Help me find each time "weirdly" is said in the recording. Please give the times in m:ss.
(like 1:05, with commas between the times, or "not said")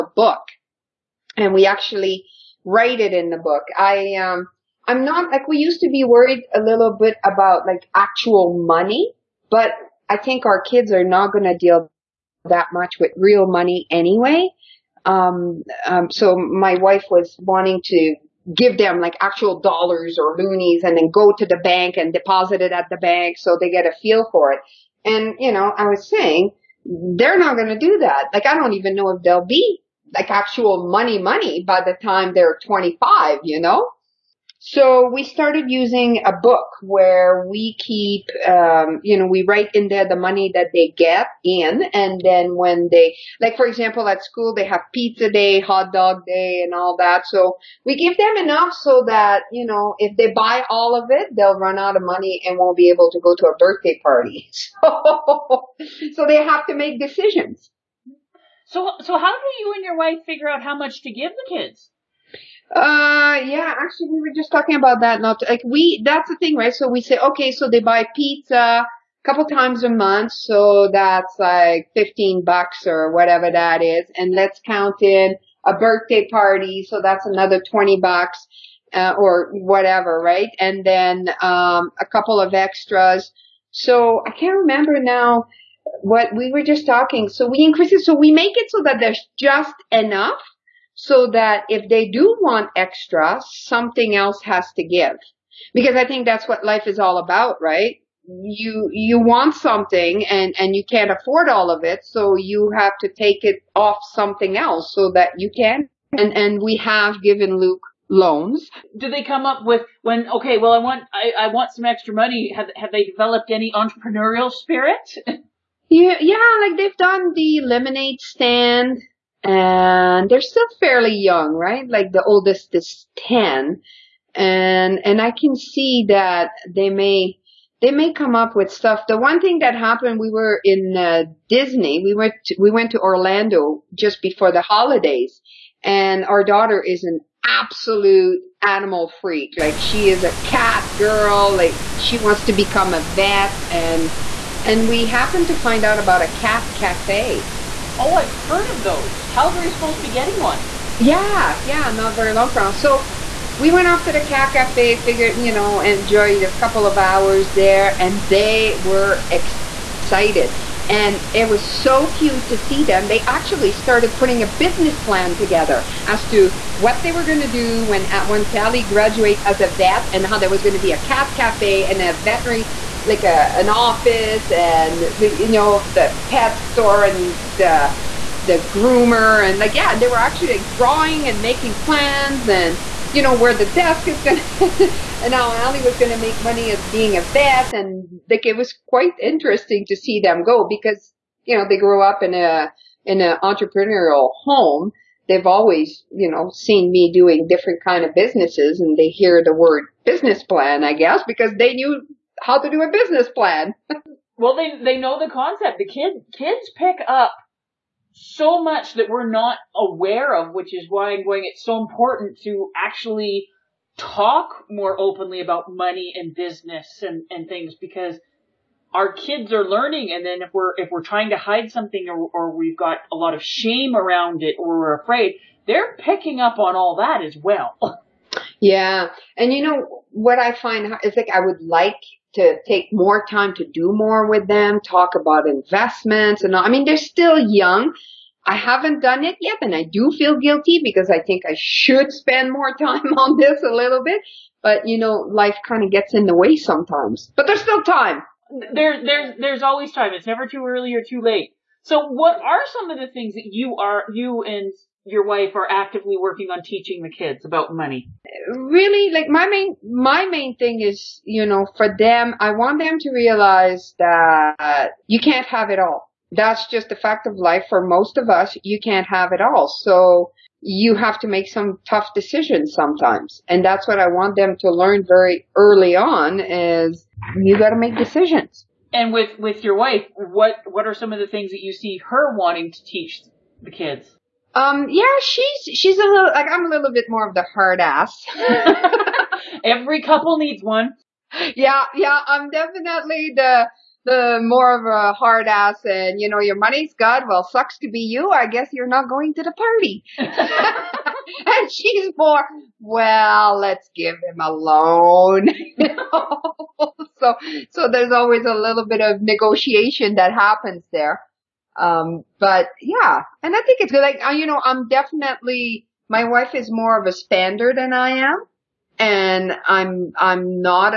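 not said.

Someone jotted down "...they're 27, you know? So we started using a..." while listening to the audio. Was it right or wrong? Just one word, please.
wrong.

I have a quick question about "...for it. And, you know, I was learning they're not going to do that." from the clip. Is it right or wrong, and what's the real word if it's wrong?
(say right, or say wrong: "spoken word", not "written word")
wrong: "saying", not "learning".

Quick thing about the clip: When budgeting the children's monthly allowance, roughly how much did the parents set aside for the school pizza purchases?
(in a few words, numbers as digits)
$15.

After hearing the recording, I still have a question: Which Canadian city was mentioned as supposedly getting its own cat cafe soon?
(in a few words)
Calgary.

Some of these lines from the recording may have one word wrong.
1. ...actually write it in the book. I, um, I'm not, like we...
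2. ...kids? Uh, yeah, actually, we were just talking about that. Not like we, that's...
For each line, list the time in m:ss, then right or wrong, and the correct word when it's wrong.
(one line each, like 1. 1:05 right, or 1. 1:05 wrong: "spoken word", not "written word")
1. 0:01 right
2. 1:01 right.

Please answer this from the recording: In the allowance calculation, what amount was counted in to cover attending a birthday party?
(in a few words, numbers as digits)
$20.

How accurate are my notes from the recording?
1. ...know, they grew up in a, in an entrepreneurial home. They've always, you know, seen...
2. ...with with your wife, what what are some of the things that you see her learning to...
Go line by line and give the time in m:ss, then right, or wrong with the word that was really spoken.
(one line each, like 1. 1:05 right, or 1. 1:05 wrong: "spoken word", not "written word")
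1. 3:11 right
2. 4:39 wrong: "wanting", not "learning".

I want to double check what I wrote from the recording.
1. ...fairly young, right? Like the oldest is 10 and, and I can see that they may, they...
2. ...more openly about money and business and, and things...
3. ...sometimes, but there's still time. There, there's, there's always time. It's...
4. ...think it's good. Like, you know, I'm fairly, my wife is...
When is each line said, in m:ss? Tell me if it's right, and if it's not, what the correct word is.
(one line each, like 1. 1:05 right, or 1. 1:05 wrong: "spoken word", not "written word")
1. 2:00 right
2. 3:34 right
3. 4:06 right
4. 5:13 wrong: "definitely", not "fairly".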